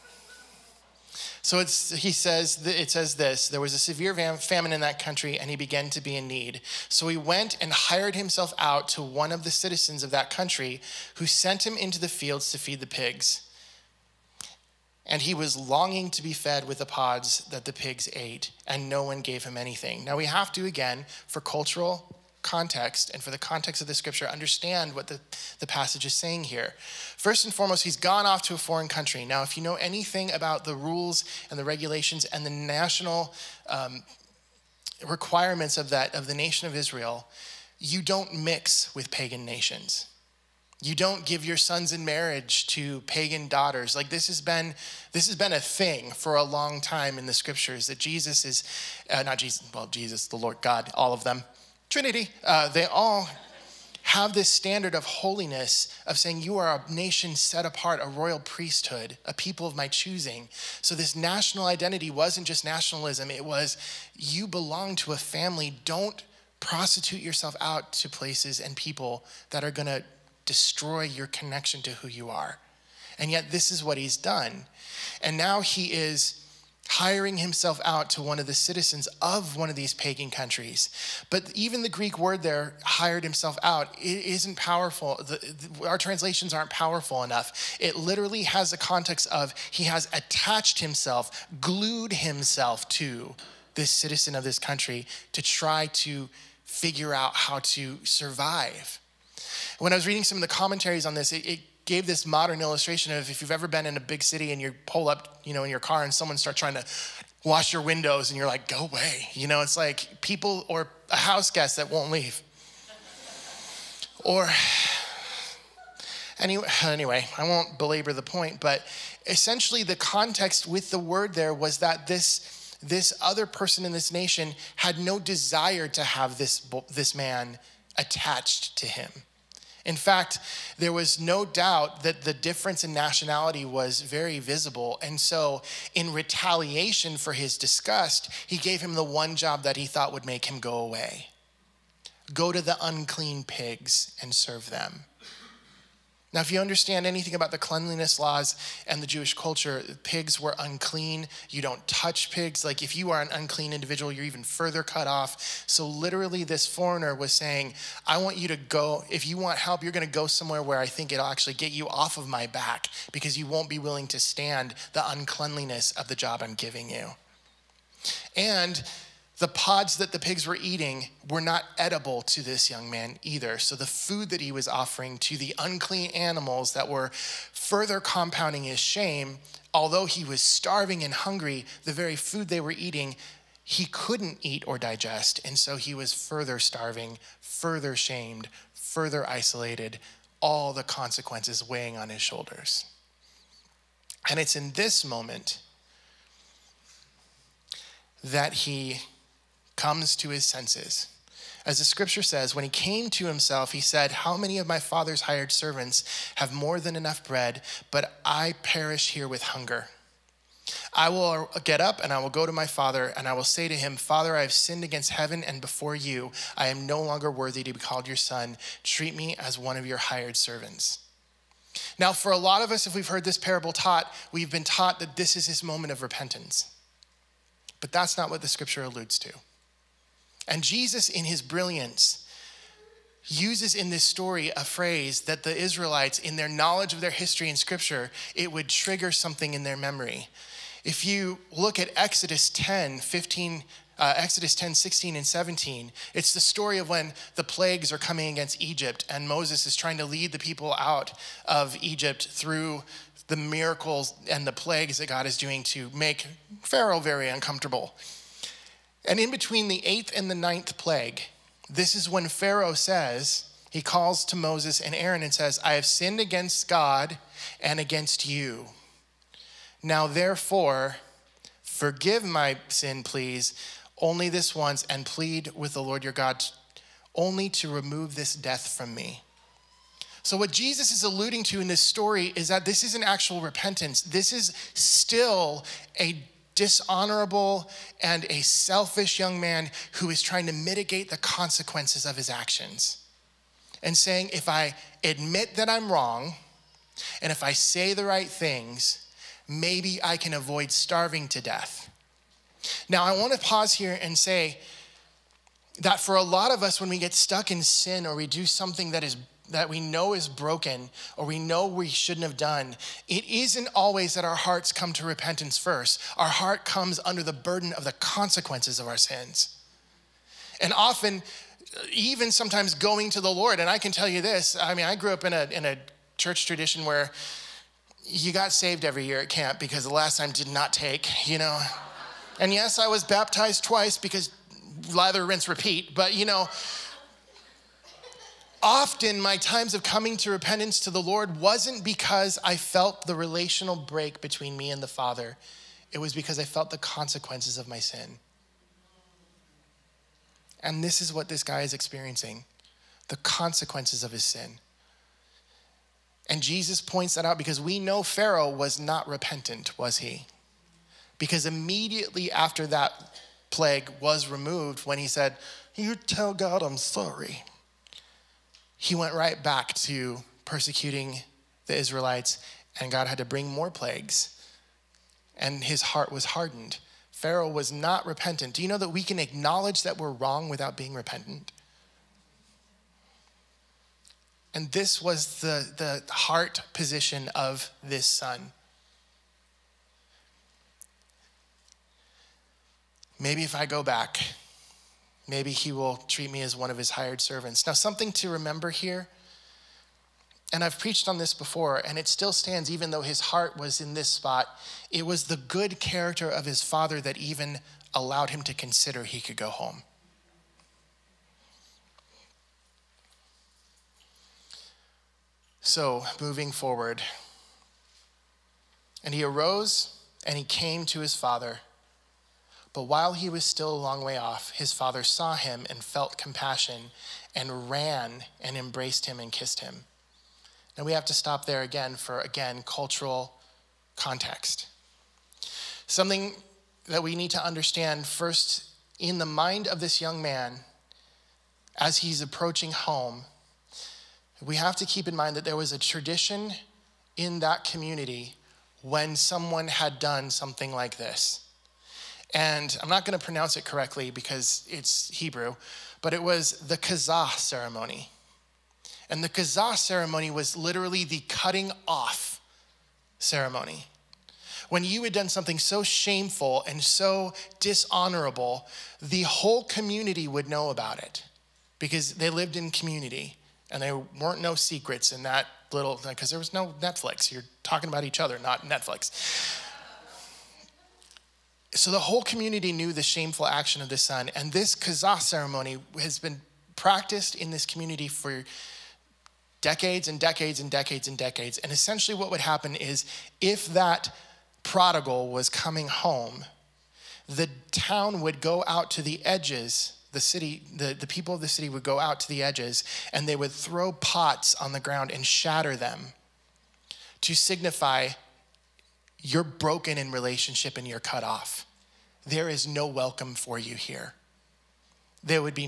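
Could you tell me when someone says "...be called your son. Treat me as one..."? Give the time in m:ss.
3:37.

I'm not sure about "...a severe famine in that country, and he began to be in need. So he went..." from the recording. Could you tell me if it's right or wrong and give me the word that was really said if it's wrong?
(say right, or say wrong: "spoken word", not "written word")
right.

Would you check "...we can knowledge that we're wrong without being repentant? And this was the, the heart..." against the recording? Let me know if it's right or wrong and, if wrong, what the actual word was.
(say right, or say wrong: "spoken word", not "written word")
wrong: "acknowledge", not "knowledge".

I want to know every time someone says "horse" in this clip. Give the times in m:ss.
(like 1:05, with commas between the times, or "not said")
not said.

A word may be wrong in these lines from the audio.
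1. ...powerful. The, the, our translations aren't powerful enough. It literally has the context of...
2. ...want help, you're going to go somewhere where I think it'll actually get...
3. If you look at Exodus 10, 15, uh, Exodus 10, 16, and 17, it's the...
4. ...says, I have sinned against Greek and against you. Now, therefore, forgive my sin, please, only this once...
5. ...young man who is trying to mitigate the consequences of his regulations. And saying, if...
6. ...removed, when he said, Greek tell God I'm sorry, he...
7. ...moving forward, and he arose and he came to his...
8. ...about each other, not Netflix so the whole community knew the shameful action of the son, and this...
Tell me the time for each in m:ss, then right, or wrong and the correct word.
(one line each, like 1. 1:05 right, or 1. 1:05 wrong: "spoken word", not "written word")
1. 1:24 right
2. 2:39 right
3. 4:00 right
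4. 4:25 wrong: "God", not "Greek"
5. 4:49 wrong: "actions", not "regulations"
6. 6:04 wrong: "You", not "Greek"
7. 6:56 right
8. 7:57 right.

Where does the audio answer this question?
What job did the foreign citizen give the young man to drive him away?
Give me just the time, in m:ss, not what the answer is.
0:12.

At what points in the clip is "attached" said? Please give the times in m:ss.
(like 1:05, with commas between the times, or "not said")
1:30, 2:07.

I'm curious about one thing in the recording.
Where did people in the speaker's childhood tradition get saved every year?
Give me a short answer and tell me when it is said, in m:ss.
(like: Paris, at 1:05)
Camp, at 5:29.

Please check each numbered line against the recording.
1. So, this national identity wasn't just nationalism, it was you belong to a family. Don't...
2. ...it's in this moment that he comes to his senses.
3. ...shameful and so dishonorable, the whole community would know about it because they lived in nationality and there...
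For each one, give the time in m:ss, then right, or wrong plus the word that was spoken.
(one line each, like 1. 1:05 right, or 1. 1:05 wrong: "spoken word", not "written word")
1. 1:00 right
2. 3:14 right
3. 7:45 wrong: "community", not "nationality".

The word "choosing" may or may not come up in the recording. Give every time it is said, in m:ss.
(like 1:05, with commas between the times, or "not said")
0:59.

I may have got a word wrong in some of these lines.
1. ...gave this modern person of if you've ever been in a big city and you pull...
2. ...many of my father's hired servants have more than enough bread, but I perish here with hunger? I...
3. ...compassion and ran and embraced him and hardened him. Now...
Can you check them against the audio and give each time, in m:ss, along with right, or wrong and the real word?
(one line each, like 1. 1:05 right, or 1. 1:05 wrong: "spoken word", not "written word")
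1. 1:41 wrong: "illustration", not "person"
2. 3:24 right
3. 7:06 wrong: "kissed", not "hardened".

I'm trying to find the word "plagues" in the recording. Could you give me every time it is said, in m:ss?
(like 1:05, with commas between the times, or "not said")
4:07, 4:14, 4:20, 6:03, 6:13.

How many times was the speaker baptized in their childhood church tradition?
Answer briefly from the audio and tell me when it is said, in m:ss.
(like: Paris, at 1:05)
Twice, at 5:33.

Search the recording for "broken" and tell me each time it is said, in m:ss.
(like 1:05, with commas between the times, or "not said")
5:10, 8:29.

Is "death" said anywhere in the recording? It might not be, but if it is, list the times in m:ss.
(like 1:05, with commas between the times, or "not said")
4:38, 5:01.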